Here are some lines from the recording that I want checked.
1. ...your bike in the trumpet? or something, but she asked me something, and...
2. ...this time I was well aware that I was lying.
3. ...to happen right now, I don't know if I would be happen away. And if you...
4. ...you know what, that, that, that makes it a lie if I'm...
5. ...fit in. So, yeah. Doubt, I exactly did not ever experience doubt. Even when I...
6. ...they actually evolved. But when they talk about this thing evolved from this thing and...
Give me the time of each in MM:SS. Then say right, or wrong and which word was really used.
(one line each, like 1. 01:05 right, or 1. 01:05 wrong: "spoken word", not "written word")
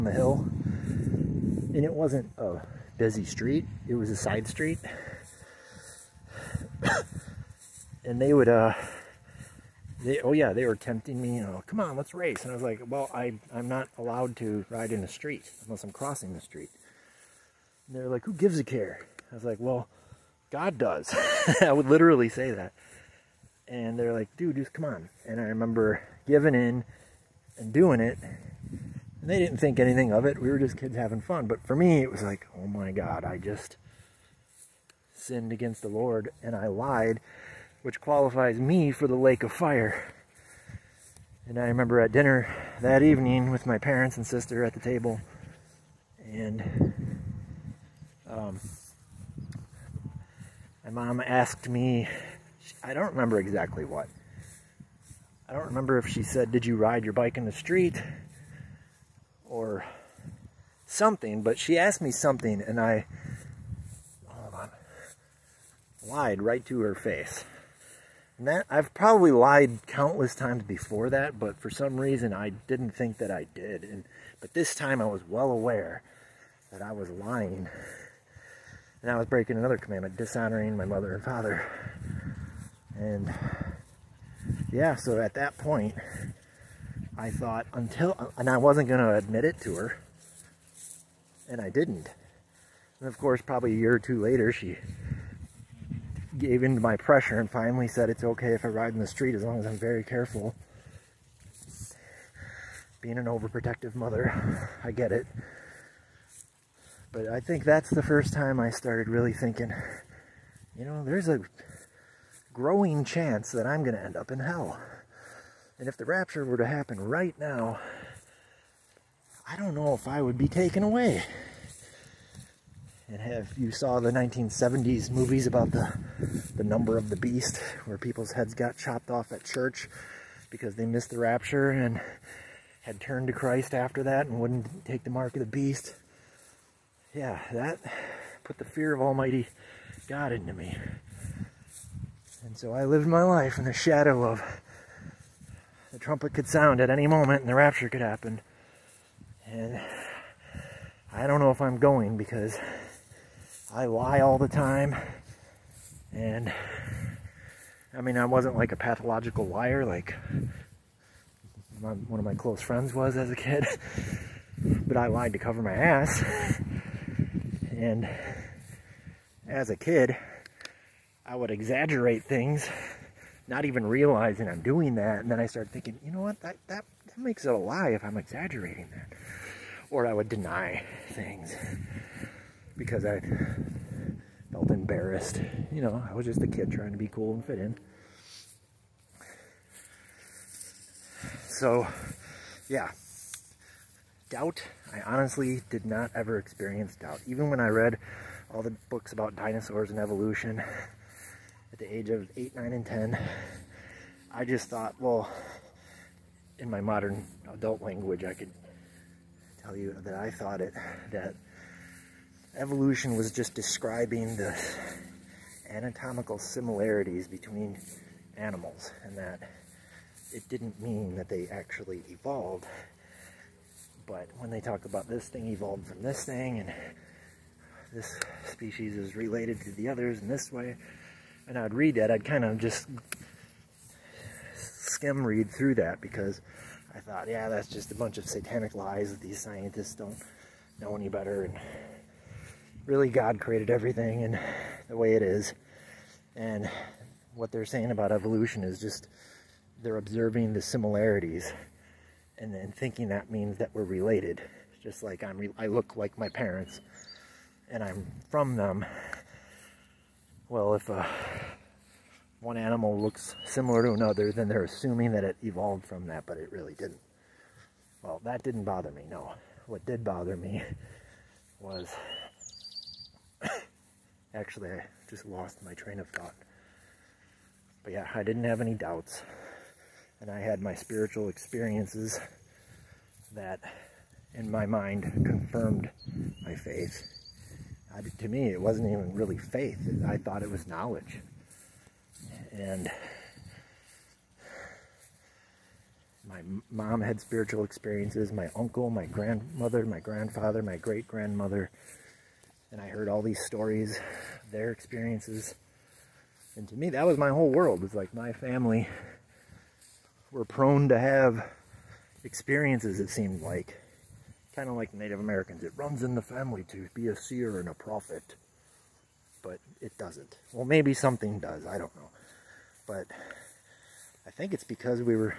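1. 00:57 wrong: "street", not "trumpet"
2. 01:14 right
3. 01:56 wrong: "taken", not "happen"
4. 02:56 right
5. 03:07 wrong: "honestly", not "exactly"
6. 03:41 right.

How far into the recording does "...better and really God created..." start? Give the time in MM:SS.
04:01.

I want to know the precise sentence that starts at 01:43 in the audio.
Being an overprotective mother, I get it.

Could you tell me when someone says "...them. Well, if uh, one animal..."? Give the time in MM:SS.
04:18.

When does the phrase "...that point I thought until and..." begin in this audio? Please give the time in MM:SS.
01:25.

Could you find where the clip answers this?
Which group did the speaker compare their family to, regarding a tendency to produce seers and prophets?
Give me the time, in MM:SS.
05:14.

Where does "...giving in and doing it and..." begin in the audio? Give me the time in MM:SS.
00:26.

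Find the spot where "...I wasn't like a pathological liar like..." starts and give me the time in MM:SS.
02:38.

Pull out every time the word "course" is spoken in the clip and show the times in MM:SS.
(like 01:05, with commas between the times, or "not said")
01:33.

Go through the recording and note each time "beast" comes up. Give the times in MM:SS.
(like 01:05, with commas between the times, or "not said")
02:07, 02:15.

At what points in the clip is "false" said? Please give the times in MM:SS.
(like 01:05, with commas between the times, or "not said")
not said.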